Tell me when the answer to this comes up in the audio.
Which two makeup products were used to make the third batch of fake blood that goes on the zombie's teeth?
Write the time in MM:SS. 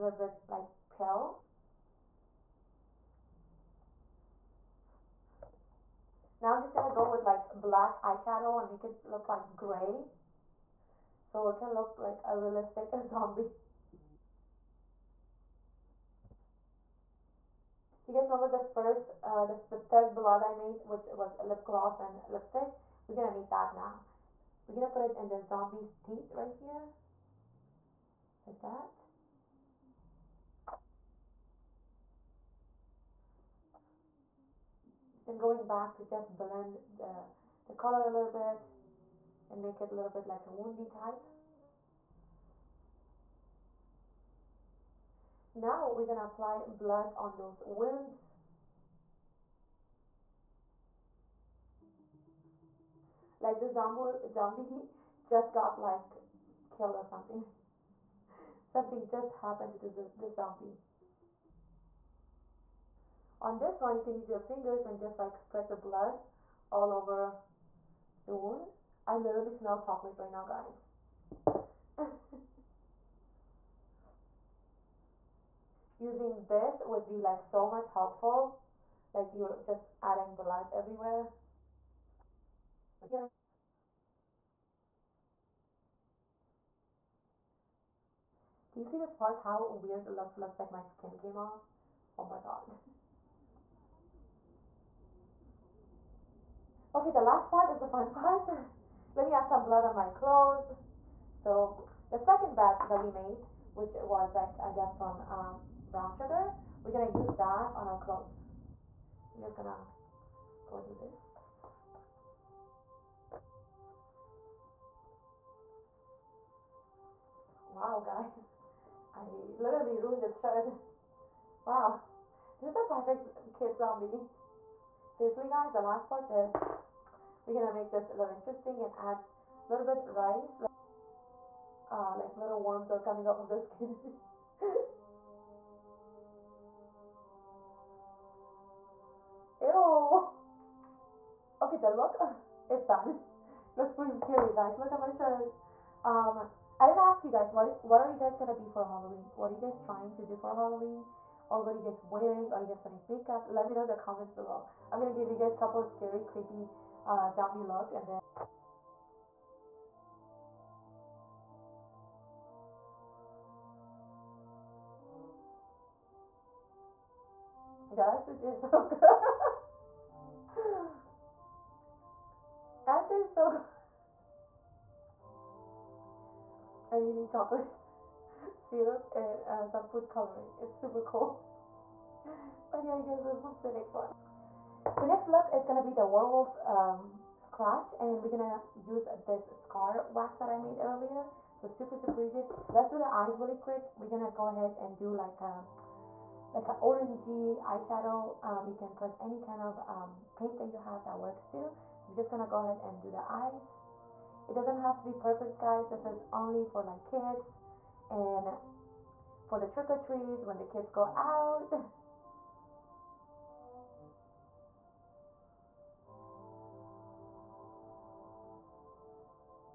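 00:21.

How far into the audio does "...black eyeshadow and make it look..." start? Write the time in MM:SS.
00:07.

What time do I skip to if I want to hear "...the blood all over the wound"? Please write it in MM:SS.
01:05.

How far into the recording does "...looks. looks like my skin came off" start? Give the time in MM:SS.
01:30.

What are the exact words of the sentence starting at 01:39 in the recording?
Let me add some blood on my clothes.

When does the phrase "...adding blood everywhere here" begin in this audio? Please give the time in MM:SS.
01:20.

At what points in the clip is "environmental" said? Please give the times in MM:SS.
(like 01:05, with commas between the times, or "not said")
not said.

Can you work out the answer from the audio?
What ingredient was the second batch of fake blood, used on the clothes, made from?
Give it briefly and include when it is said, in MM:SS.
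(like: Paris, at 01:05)
Brown sugar, at 01:45.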